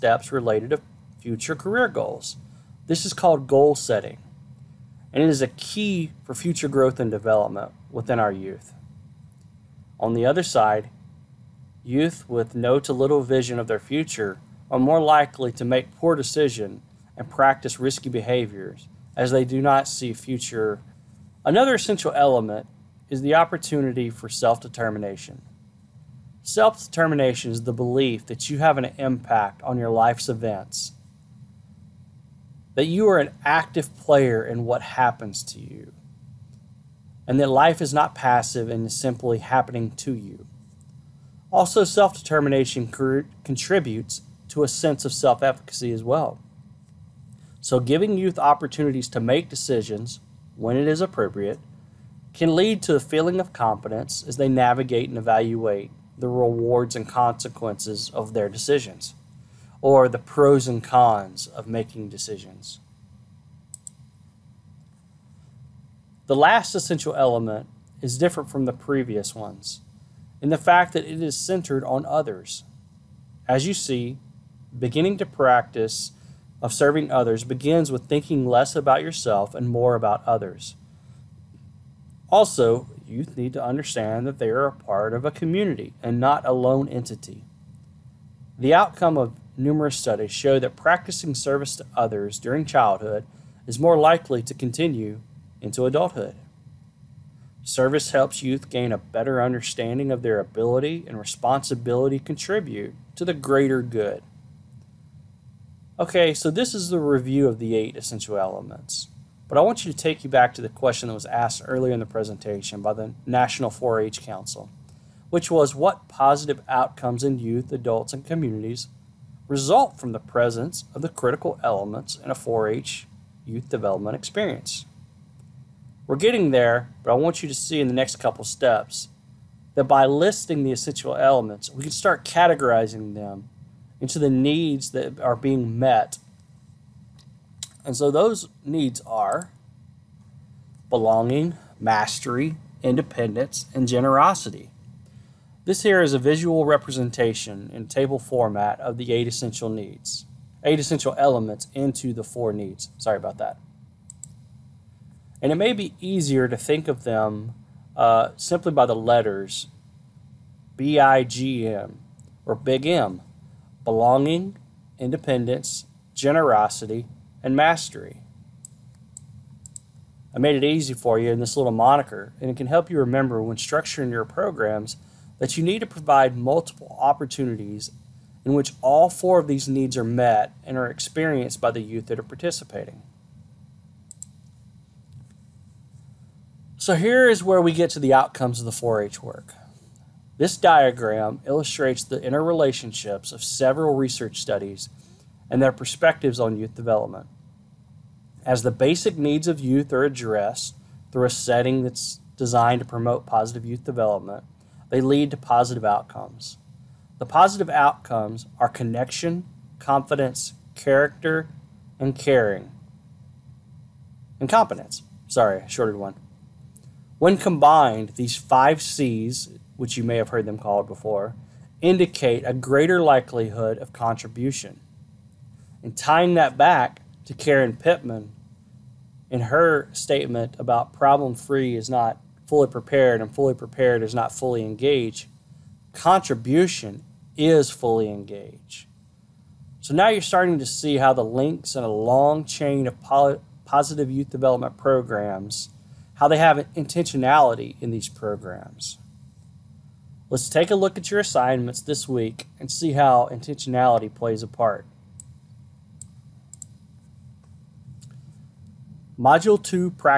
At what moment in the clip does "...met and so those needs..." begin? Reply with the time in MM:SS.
02:15.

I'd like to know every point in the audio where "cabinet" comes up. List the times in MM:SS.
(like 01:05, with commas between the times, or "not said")
not said.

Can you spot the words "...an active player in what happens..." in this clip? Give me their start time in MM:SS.
00:33.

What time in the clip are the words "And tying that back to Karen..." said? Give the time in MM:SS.
03:45.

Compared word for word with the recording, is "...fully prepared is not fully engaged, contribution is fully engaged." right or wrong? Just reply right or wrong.
right.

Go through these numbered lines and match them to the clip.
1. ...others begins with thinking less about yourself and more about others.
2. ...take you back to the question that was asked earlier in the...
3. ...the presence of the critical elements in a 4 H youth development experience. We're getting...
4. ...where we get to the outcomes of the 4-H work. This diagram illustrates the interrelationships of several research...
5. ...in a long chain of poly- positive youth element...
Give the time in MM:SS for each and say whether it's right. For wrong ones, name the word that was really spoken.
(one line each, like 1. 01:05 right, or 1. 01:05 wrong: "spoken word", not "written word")
1. 01:17 right
2. 01:49 right
3. 02:00 right
4. 03:07 right
5. 04:01 wrong: "development", not "element".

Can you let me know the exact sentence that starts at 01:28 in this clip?
The outcome of numerous studies show that practicing service to others during childhood is more likely to continue into adulthood.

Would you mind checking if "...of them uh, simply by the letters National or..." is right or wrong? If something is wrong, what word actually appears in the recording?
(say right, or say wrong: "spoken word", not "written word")
wrong: "BIGM", not "National".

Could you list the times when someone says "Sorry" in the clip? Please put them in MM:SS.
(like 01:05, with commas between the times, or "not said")
02:32, 03:35.